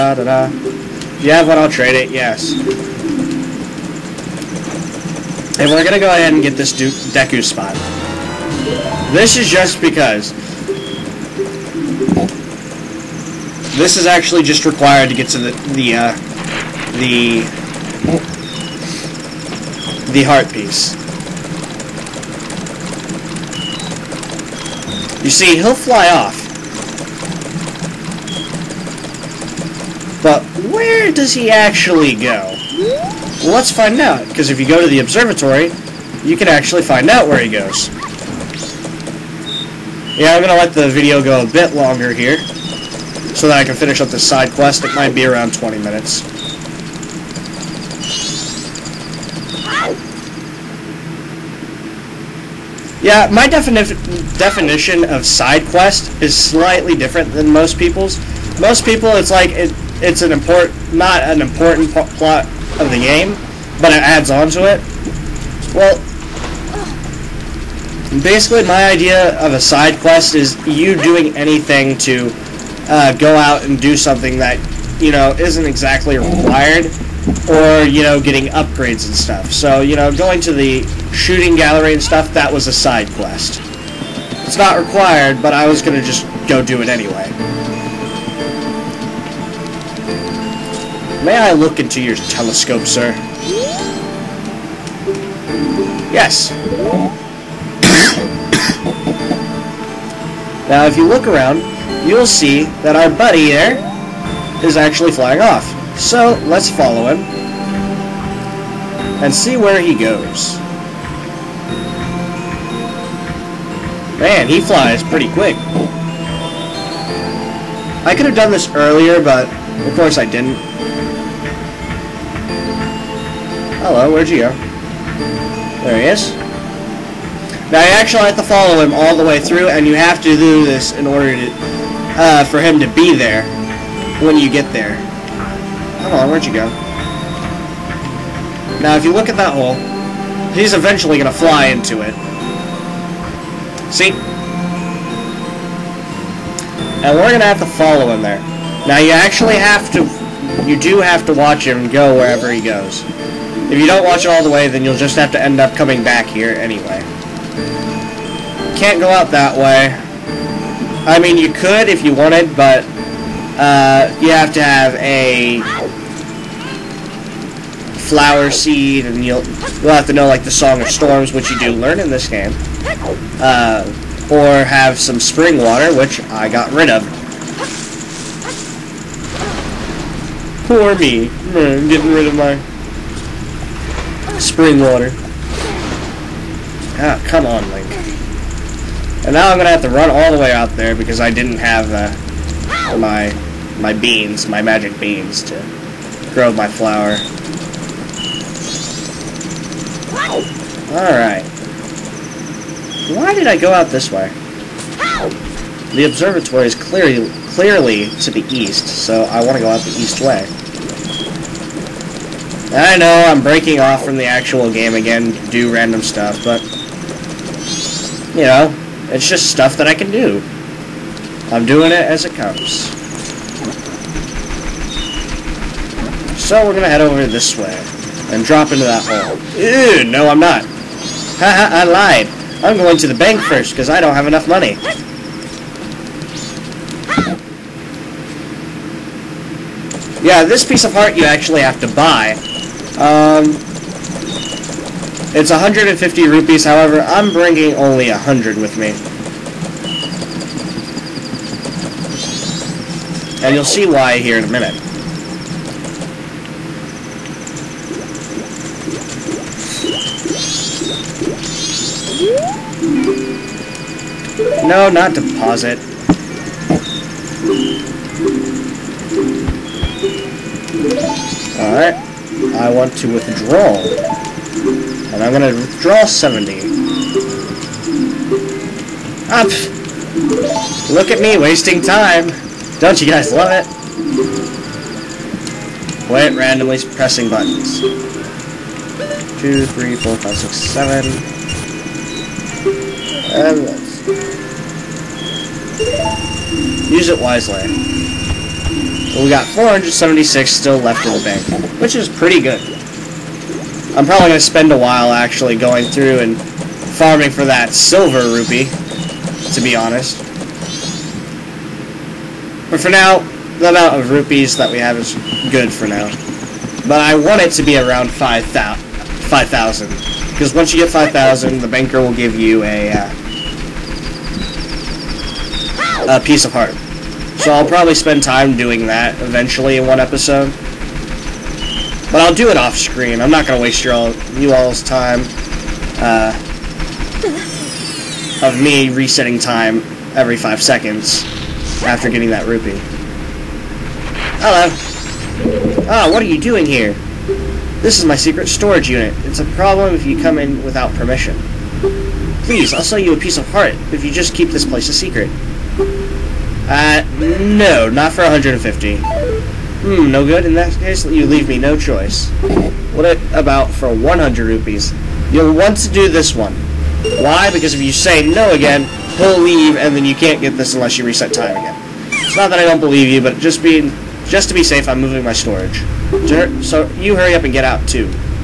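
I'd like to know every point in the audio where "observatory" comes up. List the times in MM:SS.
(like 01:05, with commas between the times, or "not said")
00:35, 03:26.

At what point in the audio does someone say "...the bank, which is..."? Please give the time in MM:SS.
05:01.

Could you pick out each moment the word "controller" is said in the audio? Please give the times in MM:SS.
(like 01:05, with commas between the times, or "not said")
not said.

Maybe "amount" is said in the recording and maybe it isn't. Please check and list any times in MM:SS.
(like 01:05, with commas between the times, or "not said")
05:13.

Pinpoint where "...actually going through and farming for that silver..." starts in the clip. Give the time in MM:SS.
05:05.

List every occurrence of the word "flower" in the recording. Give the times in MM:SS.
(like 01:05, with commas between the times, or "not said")
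02:47, 03:16.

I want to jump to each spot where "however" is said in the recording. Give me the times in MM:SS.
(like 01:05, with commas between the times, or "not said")
04:06.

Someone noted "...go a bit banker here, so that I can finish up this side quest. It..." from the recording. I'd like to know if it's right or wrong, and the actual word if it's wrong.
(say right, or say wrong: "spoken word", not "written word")
wrong: "longer", not "banker".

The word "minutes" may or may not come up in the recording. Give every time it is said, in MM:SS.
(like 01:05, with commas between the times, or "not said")
00:45, 04:14.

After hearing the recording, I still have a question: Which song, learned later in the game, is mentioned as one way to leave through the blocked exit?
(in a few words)
Song of Storms.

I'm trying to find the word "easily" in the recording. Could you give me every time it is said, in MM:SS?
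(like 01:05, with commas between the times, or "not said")
not said.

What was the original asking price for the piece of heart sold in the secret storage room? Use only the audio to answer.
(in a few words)
150 rupees.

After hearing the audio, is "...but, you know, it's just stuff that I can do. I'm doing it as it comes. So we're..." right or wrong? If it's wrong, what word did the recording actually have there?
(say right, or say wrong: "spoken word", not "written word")
right.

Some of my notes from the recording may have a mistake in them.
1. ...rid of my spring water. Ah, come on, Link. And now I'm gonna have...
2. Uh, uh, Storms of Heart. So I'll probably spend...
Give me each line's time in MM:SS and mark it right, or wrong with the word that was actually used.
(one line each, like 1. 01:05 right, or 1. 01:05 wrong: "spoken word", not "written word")
1. 03:02 right
2. 05:22 wrong: "Piece", not "Storms".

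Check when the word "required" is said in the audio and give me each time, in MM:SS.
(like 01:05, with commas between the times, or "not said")
00:14, 01:16, 01:24.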